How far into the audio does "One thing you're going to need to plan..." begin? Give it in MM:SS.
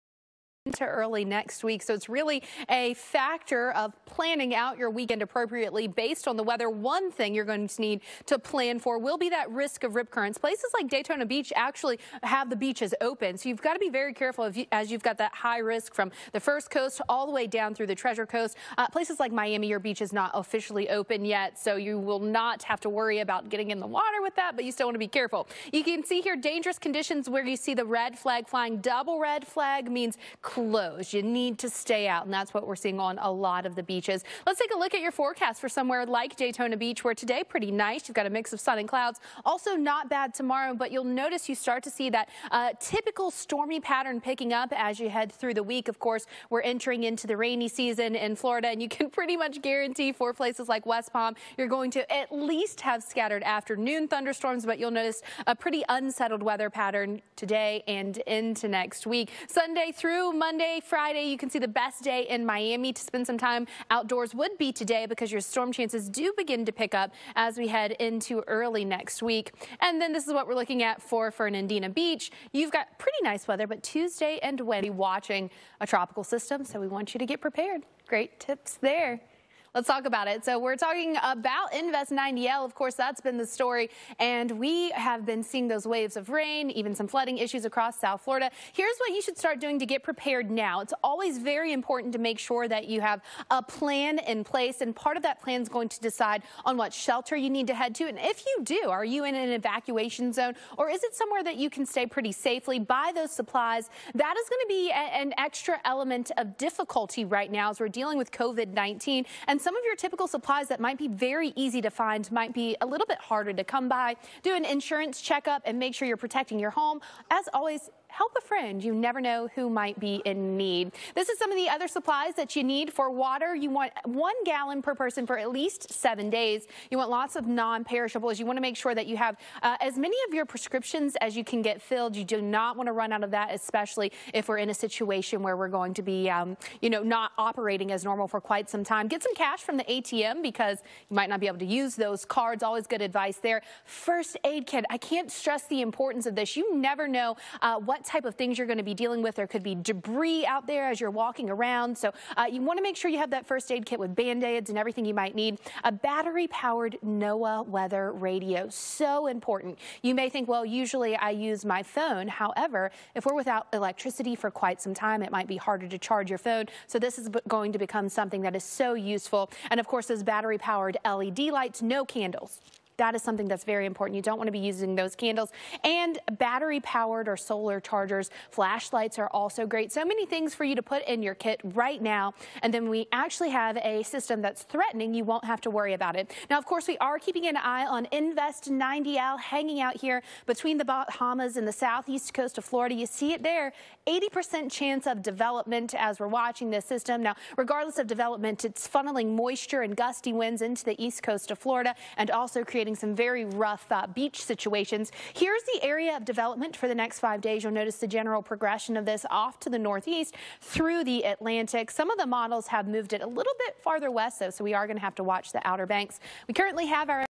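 00:06.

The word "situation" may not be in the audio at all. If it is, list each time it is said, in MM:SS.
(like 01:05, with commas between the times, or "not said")
02:14, 03:24.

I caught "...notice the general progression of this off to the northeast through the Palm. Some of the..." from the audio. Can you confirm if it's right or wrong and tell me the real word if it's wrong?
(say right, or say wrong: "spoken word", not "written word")
wrong: "Atlantic", not "Palm".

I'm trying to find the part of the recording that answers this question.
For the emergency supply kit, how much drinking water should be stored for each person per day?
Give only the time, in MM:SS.
02:04.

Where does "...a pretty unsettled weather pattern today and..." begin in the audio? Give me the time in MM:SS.
00:55.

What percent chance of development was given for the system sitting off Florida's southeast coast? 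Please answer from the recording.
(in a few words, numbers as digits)
80%.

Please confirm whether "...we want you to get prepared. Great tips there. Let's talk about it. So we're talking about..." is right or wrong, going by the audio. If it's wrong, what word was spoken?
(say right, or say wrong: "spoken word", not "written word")
right.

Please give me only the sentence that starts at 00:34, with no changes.
Let's take a look at your forecast for somewhere like Daytona Beach, where today pretty nice.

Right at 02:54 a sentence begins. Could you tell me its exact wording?
You don't want to be using those candles.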